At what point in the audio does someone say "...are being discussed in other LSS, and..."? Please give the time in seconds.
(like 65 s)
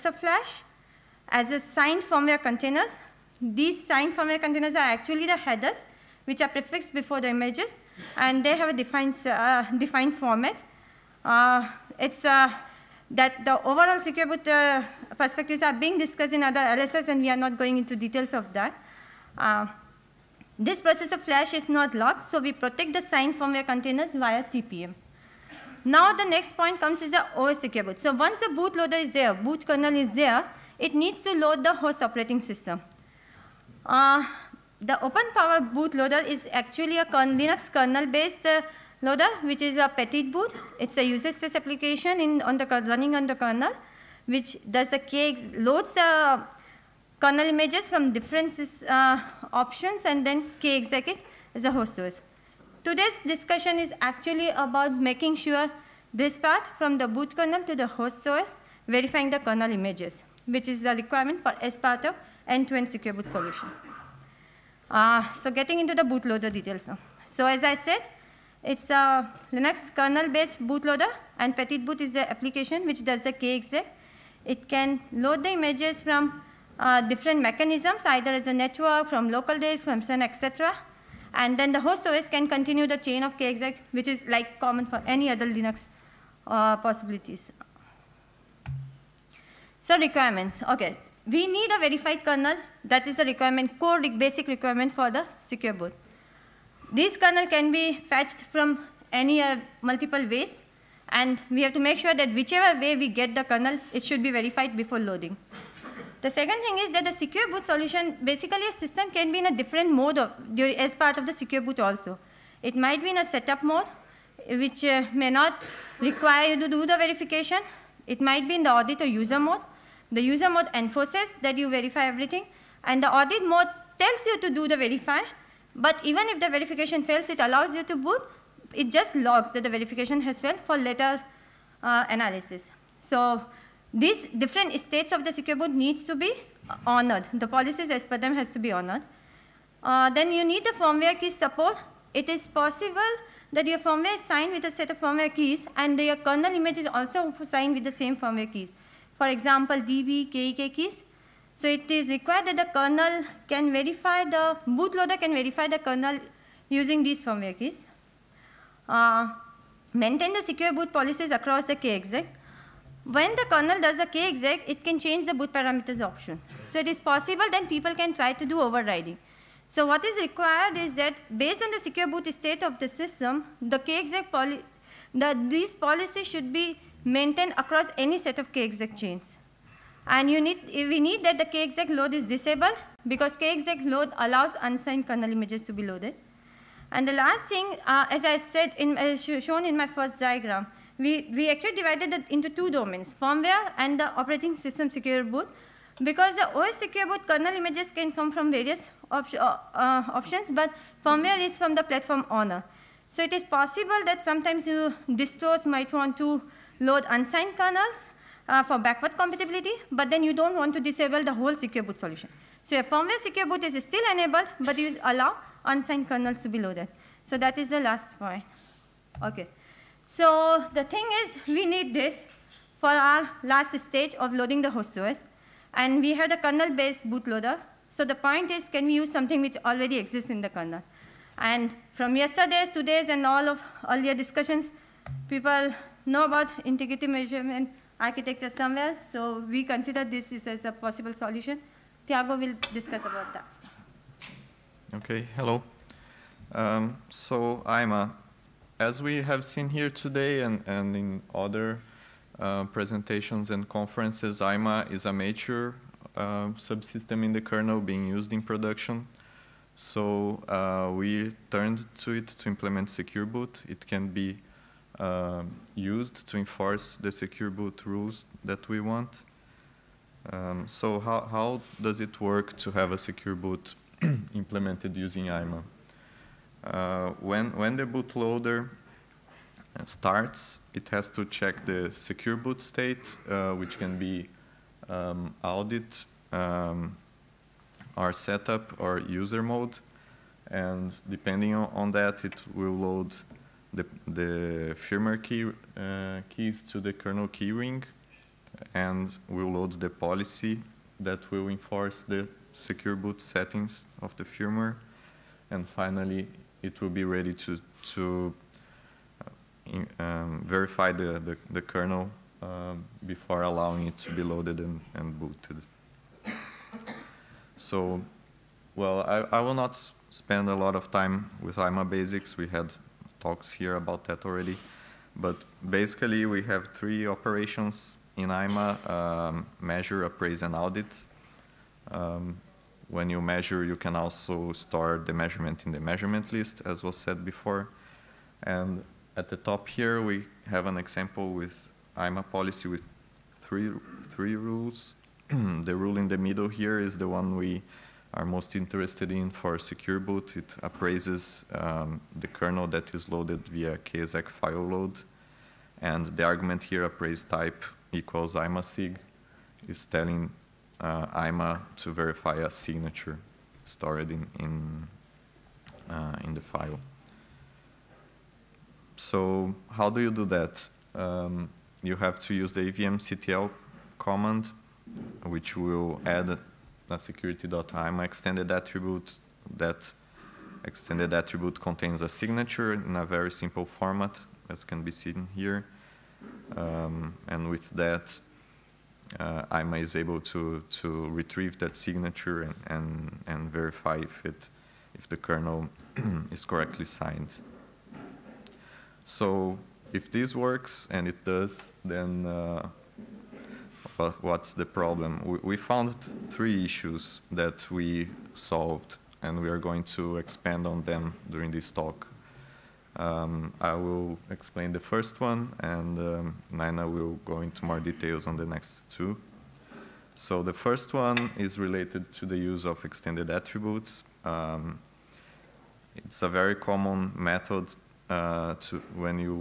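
15 s.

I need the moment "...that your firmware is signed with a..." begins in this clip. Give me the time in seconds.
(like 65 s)
143 s.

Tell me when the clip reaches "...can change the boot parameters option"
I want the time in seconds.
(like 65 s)
164 s.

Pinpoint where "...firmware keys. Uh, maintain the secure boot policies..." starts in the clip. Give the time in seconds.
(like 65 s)
157 s.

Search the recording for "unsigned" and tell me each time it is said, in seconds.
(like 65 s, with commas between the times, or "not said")
184 s, 207 s, 215 s.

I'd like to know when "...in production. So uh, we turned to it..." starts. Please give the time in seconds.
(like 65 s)
258 s.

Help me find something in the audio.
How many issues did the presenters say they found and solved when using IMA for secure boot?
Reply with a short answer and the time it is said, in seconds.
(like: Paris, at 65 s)
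3, at 406 s.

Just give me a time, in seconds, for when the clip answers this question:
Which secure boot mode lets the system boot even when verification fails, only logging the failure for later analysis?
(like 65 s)
123 s.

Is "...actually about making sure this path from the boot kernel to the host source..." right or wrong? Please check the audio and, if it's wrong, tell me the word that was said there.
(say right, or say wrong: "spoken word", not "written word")
right.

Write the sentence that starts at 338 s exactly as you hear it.
And at the top here, we have an example with IMA policy with three, three rules.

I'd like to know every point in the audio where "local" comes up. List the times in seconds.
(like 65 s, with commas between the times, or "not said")
79 s.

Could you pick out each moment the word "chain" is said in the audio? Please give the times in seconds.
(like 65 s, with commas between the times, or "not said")
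82 s, 178 s.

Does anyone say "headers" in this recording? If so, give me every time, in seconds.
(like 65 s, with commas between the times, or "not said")
5 s.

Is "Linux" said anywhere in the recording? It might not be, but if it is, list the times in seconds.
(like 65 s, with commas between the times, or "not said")
37 s, 69 s, 85 s.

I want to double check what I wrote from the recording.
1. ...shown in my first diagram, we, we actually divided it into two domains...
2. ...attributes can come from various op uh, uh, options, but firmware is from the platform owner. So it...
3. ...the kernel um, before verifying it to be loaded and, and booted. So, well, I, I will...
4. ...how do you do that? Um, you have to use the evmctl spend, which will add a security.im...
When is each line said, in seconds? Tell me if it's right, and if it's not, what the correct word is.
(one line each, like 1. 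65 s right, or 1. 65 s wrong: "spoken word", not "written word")
1. 189 s right
2. 197 s wrong: "images", not "attributes"
3. 311 s wrong: "allowing", not "verifying"
4. 369 s wrong: "command", not "spend".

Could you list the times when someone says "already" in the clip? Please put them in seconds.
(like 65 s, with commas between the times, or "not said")
229 s, 324 s.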